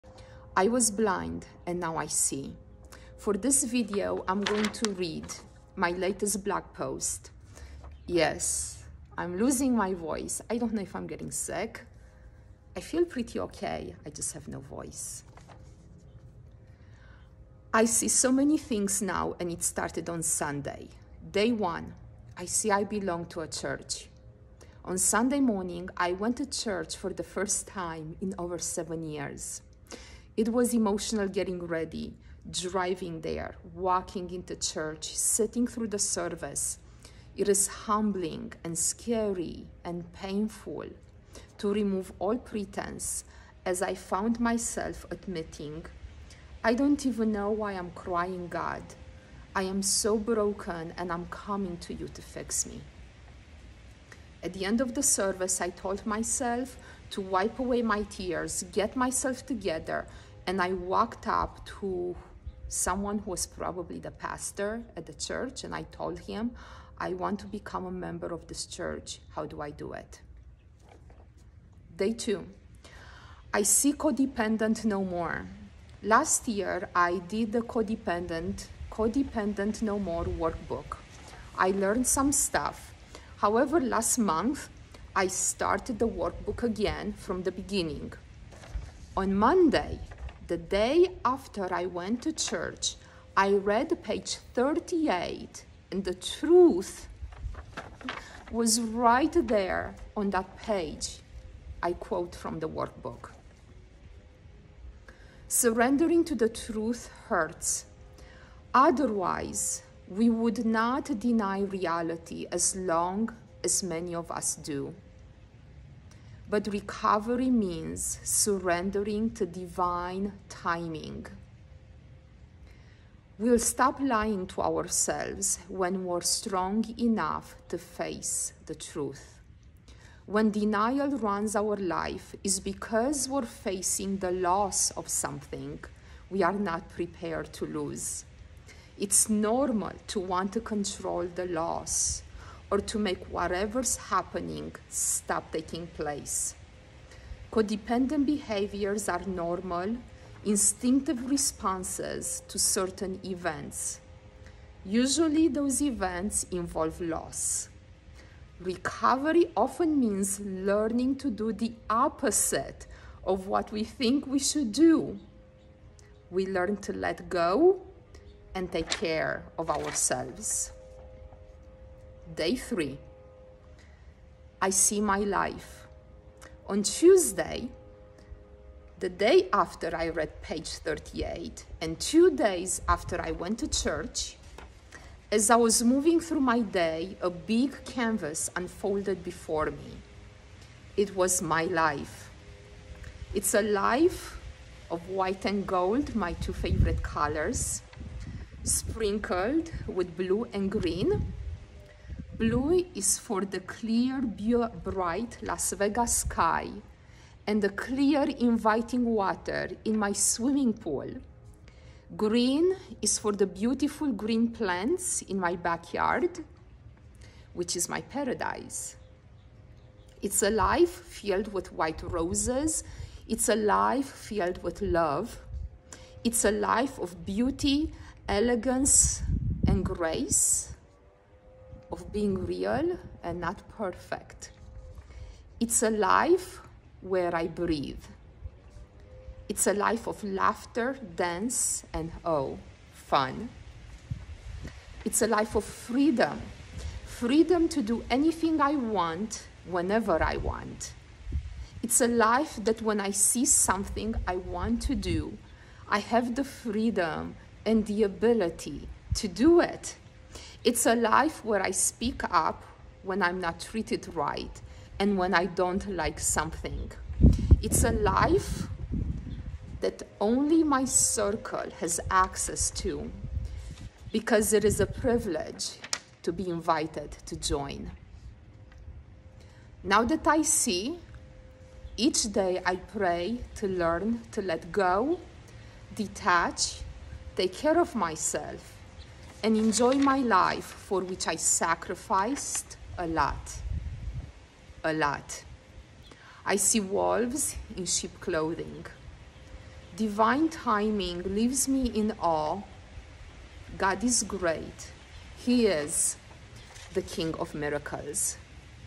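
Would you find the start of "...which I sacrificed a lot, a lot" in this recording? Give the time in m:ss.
4:51.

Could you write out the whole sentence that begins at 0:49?
I am so broken and I'm coming to you to fix me.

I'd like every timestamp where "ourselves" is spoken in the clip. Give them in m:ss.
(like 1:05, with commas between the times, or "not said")
2:04, 2:49.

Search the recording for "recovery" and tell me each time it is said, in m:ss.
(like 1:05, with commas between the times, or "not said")
1:56, 2:38.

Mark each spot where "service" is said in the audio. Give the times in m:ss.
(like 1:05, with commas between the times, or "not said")
0:35, 0:55.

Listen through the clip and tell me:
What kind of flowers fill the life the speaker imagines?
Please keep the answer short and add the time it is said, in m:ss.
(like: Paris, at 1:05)
white roses, at 3:41.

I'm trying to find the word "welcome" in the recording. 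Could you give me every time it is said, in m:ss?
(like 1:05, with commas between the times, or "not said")
not said.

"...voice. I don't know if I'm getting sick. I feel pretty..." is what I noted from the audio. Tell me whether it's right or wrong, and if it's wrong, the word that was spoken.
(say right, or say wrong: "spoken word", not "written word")
right.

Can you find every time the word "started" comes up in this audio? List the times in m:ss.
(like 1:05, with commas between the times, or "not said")
0:19, 1:25.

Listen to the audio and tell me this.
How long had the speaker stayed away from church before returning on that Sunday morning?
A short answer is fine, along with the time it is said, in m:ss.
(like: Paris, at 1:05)
over 7 years, at 0:28.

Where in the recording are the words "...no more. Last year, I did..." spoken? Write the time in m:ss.
1:14.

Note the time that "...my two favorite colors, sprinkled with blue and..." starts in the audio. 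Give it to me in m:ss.
3:16.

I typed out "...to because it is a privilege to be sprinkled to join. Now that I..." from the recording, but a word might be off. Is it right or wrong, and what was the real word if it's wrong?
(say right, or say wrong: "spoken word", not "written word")
wrong: "invited", not "sprinkled".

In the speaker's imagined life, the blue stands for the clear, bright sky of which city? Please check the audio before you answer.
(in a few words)
Las Vegas.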